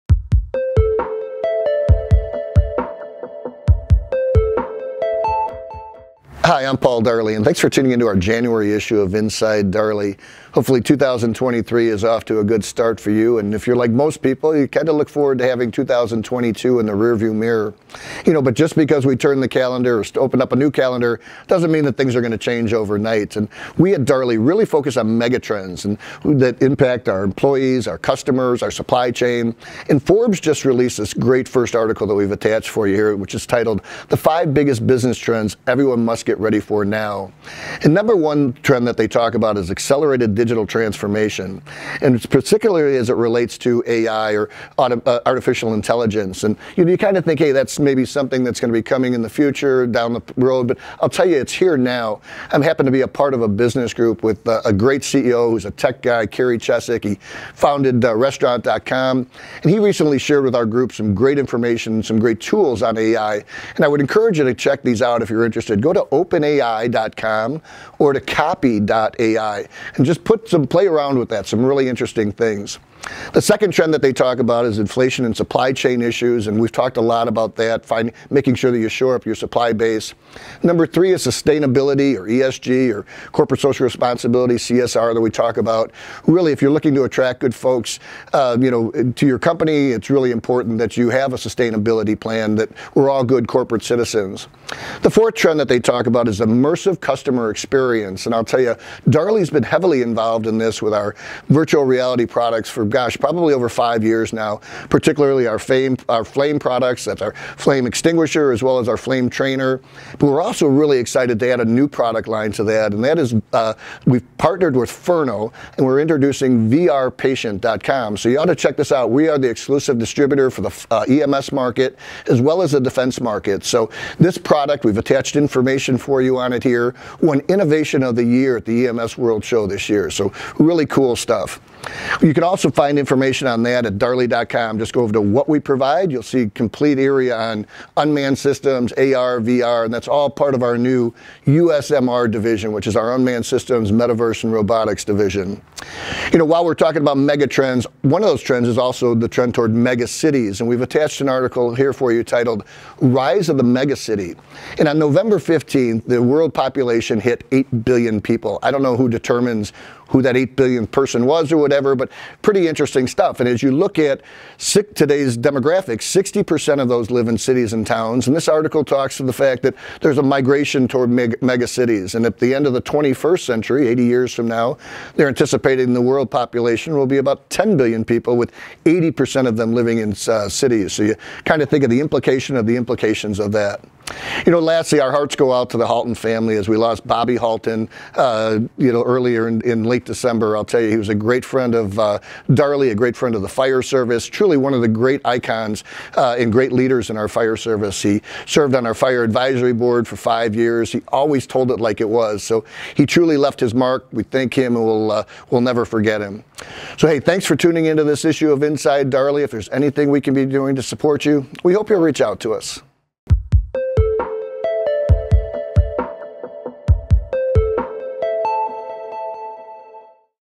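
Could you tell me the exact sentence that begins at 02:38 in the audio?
I don't know who determines who that 8 billionth person was or whatever, but pretty interesting stuff.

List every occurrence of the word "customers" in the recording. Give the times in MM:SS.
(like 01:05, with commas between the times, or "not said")
00:27, 01:36.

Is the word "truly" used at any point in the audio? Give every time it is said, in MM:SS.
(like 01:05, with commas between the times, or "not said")
03:14, 03:23.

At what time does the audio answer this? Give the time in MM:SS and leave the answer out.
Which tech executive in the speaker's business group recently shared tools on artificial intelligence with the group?
00:56.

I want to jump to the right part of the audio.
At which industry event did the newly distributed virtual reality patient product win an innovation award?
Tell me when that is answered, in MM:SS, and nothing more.
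02:08.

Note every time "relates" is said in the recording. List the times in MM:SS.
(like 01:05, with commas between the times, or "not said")
00:43.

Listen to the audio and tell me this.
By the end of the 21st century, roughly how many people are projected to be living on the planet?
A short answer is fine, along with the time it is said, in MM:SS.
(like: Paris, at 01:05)
10 billion, at 02:57.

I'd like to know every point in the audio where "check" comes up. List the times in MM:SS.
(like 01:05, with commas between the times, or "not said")
01:04, 01:58.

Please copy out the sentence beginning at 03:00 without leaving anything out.
So you kind of think of the implication of the implications of that.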